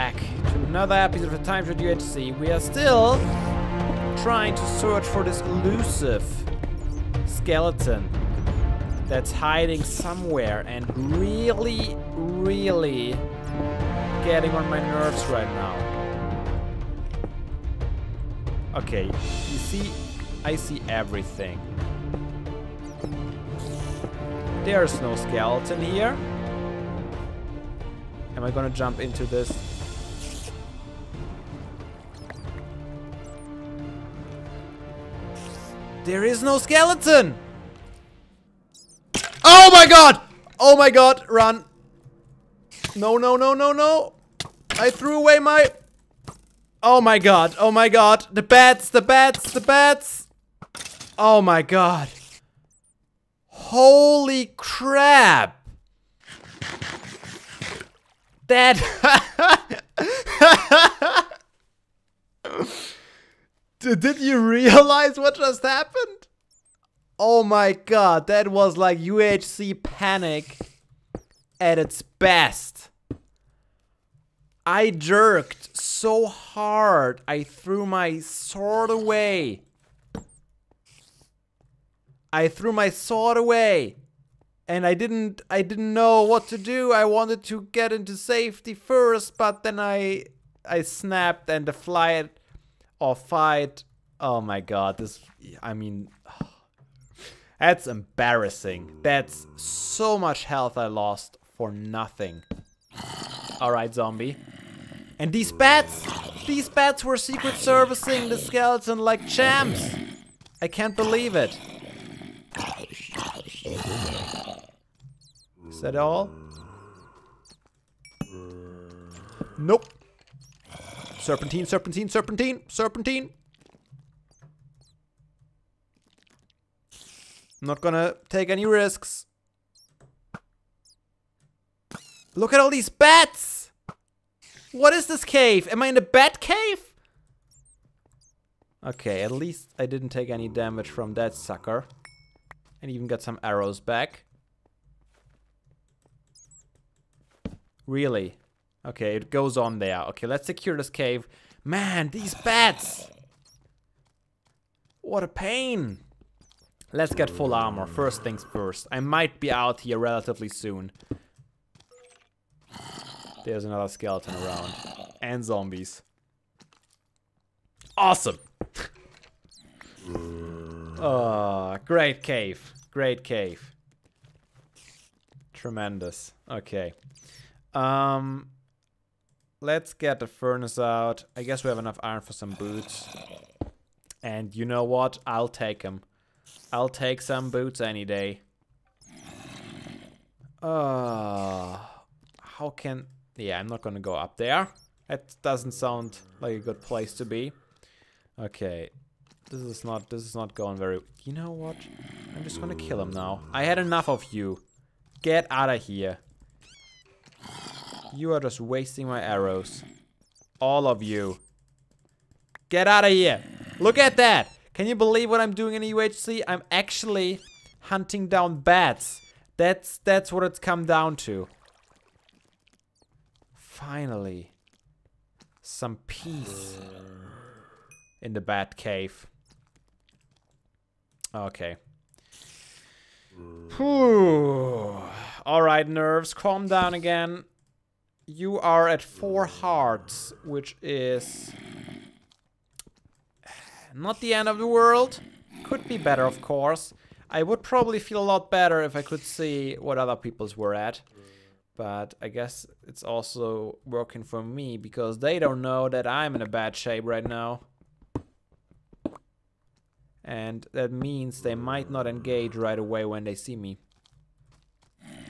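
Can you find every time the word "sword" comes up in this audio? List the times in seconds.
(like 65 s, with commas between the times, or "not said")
78 s, 82 s.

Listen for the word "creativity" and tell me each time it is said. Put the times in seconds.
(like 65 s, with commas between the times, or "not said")
not said.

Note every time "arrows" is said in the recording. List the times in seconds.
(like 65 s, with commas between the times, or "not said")
143 s, 209 s.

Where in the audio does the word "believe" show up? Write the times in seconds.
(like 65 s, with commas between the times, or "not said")
110 s, 214 s.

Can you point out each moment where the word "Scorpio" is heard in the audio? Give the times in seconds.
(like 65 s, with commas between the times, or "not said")
not said.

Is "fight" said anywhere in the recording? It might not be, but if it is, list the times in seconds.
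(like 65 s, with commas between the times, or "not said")
93 s.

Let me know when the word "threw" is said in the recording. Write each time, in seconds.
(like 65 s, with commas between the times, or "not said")
44 s, 77 s, 82 s.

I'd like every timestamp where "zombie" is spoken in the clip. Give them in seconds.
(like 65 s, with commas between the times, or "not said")
103 s, 165 s.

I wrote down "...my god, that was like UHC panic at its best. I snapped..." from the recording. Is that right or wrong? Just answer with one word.
wrong.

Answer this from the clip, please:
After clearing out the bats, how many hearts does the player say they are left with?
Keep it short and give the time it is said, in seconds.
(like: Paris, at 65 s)
4, at 239 s.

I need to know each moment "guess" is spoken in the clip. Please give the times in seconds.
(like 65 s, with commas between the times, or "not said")
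181 s, 252 s.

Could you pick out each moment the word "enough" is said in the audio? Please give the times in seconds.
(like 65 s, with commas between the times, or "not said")
181 s, 203 s.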